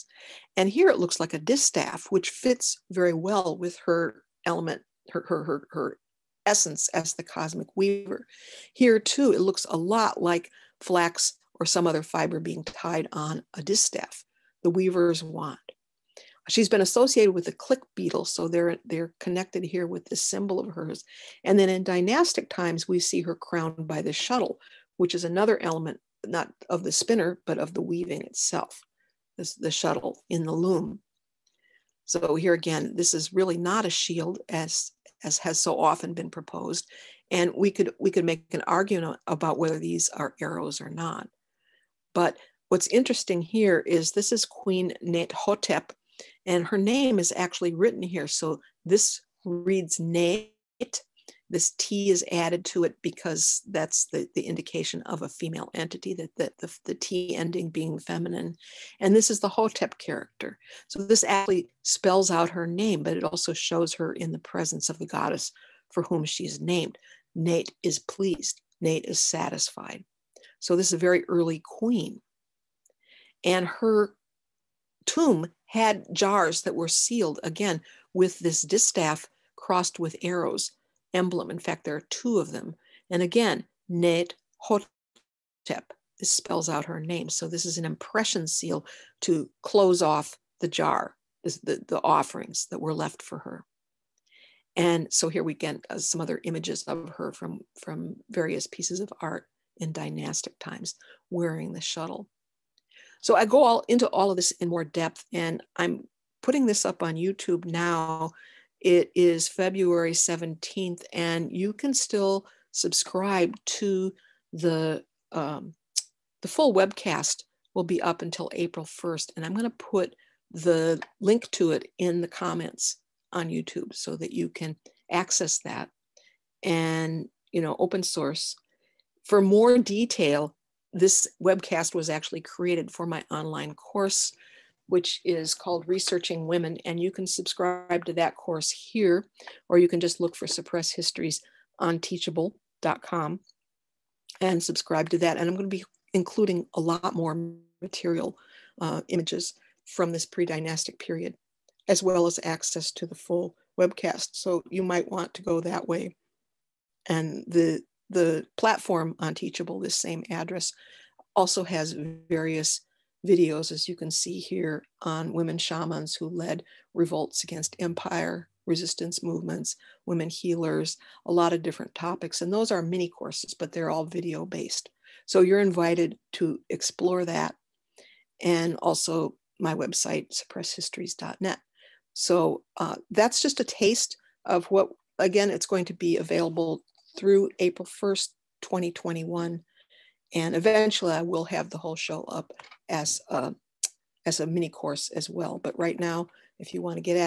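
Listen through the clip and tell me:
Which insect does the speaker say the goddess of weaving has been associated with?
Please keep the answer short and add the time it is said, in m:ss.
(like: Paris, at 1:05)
Click beetle, at 0:17.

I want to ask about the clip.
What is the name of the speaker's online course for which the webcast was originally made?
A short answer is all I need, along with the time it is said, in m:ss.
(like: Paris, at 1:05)
Researching Women, at 2:15.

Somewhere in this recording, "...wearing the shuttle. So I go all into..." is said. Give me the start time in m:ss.
1:41.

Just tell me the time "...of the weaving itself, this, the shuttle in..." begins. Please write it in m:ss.
0:27.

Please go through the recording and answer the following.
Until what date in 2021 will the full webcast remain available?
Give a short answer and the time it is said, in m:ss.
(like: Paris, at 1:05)
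April 1st, 2021, at 3:07.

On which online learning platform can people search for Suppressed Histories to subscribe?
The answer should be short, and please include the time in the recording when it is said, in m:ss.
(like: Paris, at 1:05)
Teachable, at 2:22.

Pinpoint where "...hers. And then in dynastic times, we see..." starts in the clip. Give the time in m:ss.
0:20.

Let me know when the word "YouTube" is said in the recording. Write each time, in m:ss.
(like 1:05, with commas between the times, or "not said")
1:47, 2:03.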